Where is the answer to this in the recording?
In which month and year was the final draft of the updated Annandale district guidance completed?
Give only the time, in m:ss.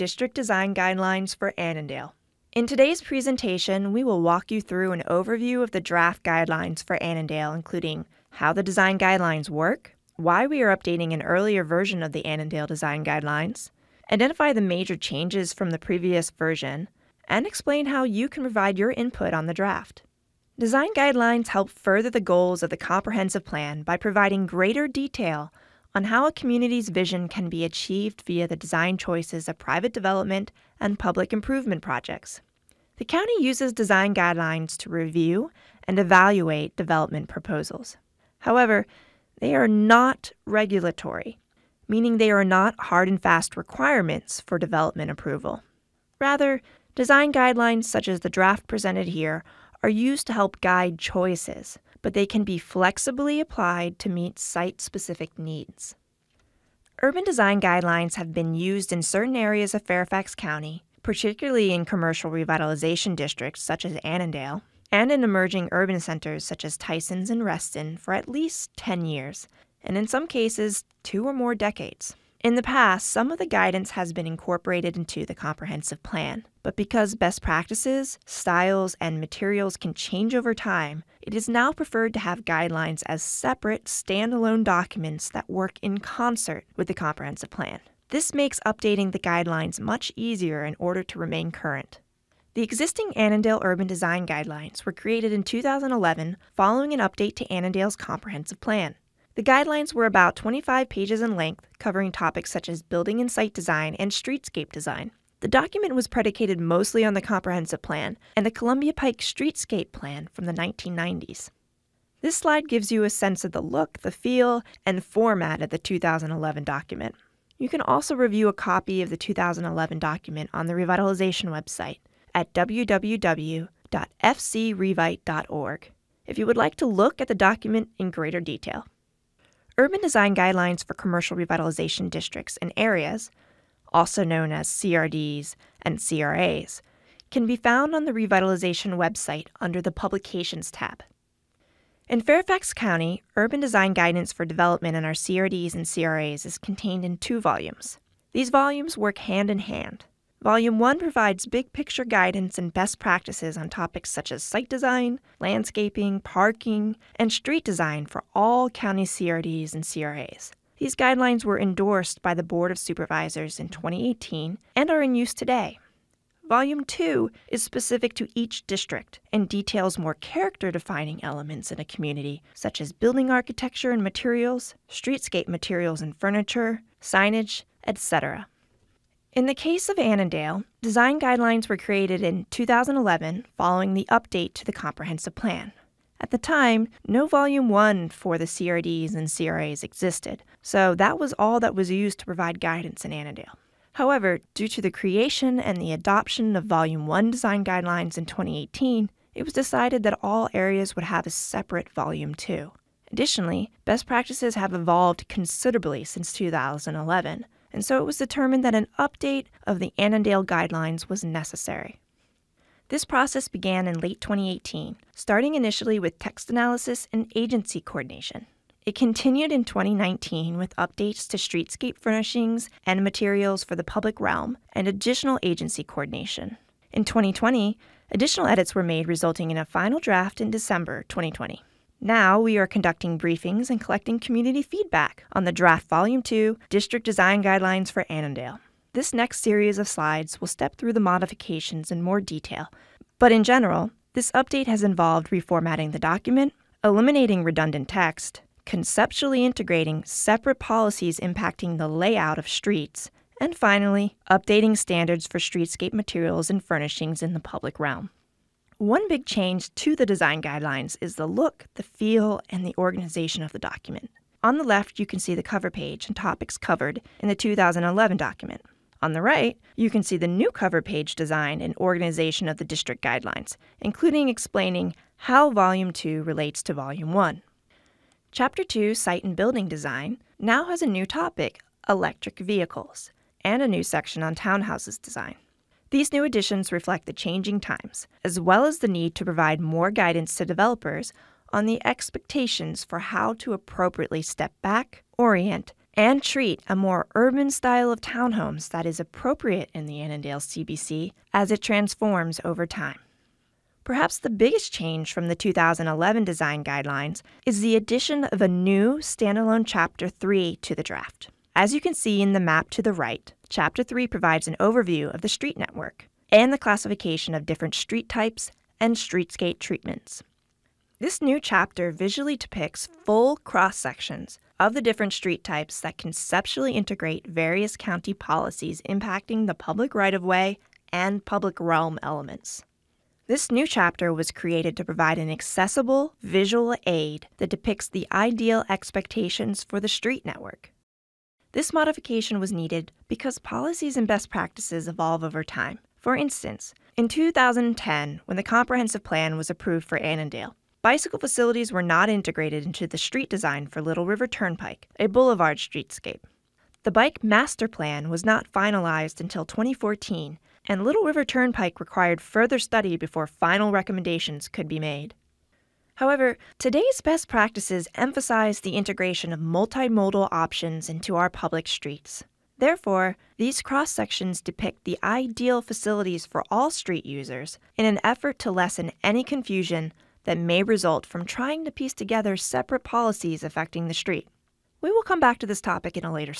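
3:50.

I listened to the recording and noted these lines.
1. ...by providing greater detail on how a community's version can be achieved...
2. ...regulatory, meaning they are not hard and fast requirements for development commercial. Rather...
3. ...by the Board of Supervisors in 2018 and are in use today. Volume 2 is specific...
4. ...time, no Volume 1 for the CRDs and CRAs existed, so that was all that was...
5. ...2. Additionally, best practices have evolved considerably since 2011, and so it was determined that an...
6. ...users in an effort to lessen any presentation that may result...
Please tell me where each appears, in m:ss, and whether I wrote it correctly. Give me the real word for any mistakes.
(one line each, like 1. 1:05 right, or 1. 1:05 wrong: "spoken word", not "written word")
1. 0:23 wrong: "vision", not "version"
2. 0:40 wrong: "approval", not "commercial"
3. 2:42 right
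4. 3:06 right
5. 3:22 right
6. 6:17 wrong: "confusion", not "presentation".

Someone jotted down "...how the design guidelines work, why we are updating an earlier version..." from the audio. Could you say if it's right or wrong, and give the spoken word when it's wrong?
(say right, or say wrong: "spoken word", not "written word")
right.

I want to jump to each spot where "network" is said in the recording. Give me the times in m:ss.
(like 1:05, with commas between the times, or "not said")
5:15, 5:40.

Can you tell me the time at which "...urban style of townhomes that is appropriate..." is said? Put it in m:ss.
4:57.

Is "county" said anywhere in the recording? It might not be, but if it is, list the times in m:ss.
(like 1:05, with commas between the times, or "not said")
0:33, 1:00, 2:22, 2:38, 5:27.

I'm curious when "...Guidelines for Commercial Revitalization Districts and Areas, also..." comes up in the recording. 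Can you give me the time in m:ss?
2:10.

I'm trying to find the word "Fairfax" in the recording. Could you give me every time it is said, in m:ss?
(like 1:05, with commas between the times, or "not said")
0:59, 2:22.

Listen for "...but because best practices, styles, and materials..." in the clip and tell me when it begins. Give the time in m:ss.
1:16.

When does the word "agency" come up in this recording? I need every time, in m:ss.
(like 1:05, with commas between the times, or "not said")
3:37, 3:45.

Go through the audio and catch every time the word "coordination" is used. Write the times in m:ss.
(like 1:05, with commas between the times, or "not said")
3:37, 3:45.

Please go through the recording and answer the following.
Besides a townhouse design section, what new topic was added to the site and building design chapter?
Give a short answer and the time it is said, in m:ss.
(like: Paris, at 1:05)
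electric vehicles, at 4:41.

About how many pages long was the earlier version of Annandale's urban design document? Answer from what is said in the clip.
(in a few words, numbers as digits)
25.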